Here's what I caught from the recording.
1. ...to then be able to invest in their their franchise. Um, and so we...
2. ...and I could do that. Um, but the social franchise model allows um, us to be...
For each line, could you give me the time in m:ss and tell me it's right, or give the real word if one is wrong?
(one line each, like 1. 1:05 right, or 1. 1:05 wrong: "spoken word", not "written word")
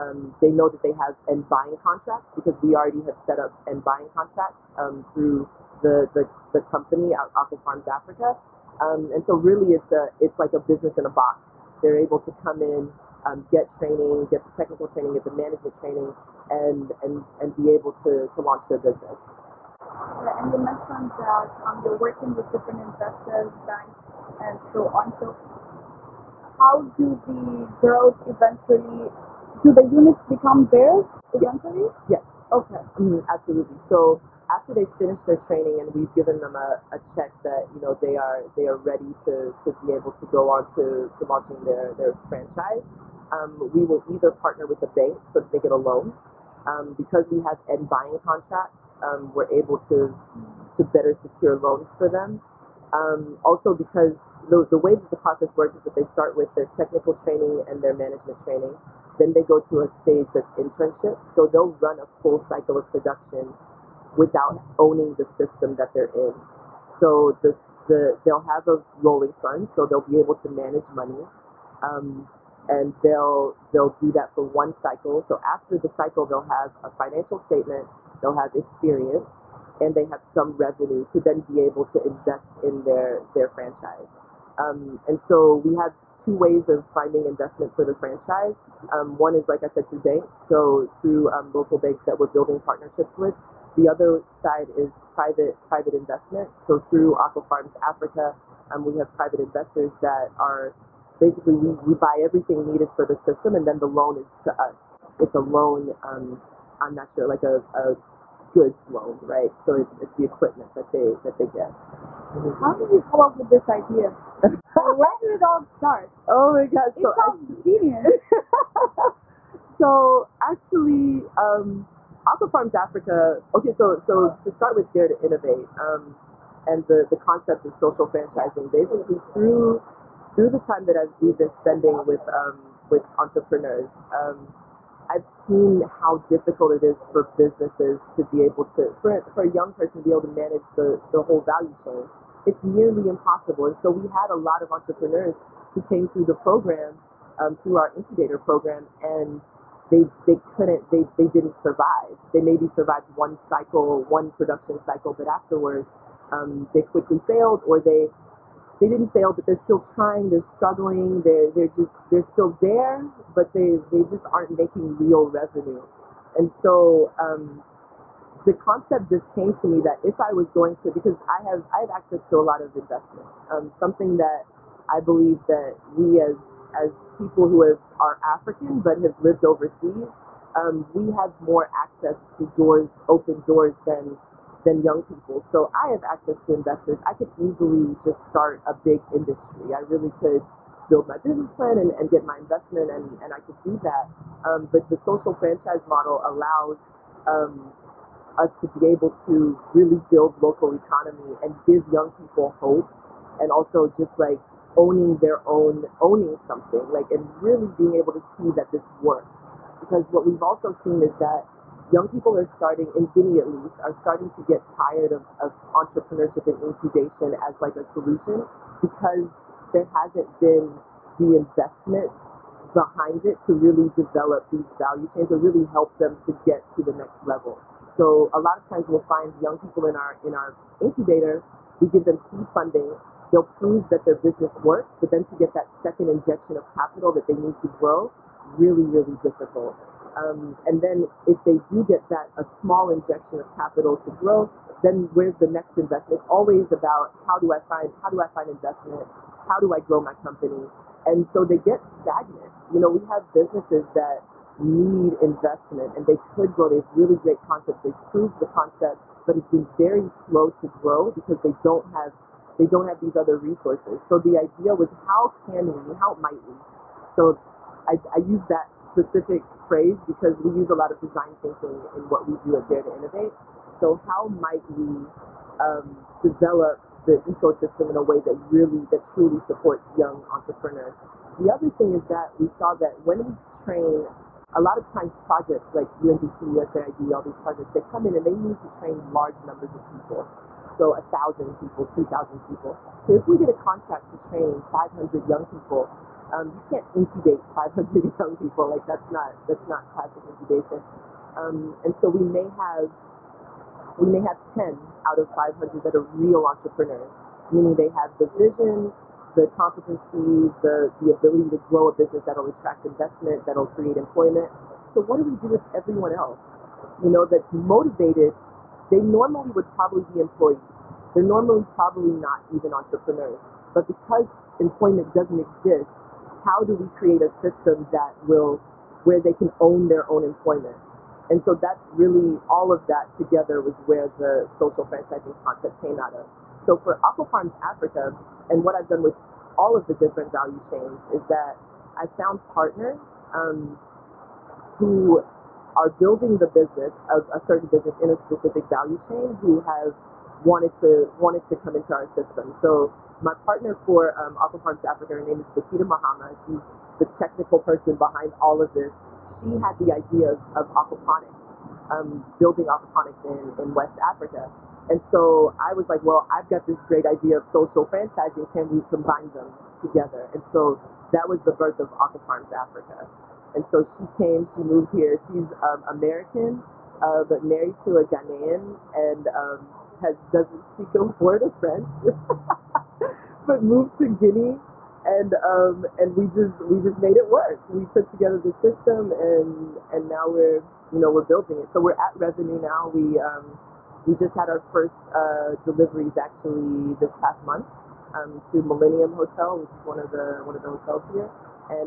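1. 1:21 right
2. 3:13 right.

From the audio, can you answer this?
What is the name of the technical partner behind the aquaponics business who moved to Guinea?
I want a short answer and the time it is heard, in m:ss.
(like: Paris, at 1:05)
Bakita Mahama, at 5:55.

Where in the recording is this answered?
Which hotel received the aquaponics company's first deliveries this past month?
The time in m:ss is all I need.
6:38.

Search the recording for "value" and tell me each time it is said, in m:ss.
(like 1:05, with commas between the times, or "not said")
2:21, 3:44, 5:40, 5:48.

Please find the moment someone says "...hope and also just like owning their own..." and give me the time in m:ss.
3:22.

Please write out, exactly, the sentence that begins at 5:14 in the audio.
So what do we do with everyone else?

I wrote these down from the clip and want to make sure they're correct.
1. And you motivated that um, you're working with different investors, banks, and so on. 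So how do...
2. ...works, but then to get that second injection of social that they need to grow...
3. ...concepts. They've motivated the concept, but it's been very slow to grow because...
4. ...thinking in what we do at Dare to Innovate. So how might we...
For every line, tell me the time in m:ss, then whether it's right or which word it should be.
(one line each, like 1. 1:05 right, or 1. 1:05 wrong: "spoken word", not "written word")
1. 0:19 wrong: "mentioned", not "motivated"
2. 3:54 wrong: "capital", not "social"
3. 4:17 wrong: "proved", not "motivated"
4. 4:31 right.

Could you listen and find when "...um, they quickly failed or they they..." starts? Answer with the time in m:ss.
2:36.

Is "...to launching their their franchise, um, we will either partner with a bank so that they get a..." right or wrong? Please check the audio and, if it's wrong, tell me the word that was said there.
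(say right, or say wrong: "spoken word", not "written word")
right.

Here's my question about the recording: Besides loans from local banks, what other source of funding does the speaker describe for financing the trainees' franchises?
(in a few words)
Private investment.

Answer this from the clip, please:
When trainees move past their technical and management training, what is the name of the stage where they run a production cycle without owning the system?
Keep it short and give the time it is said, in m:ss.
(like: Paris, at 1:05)
Internship, at 1:00.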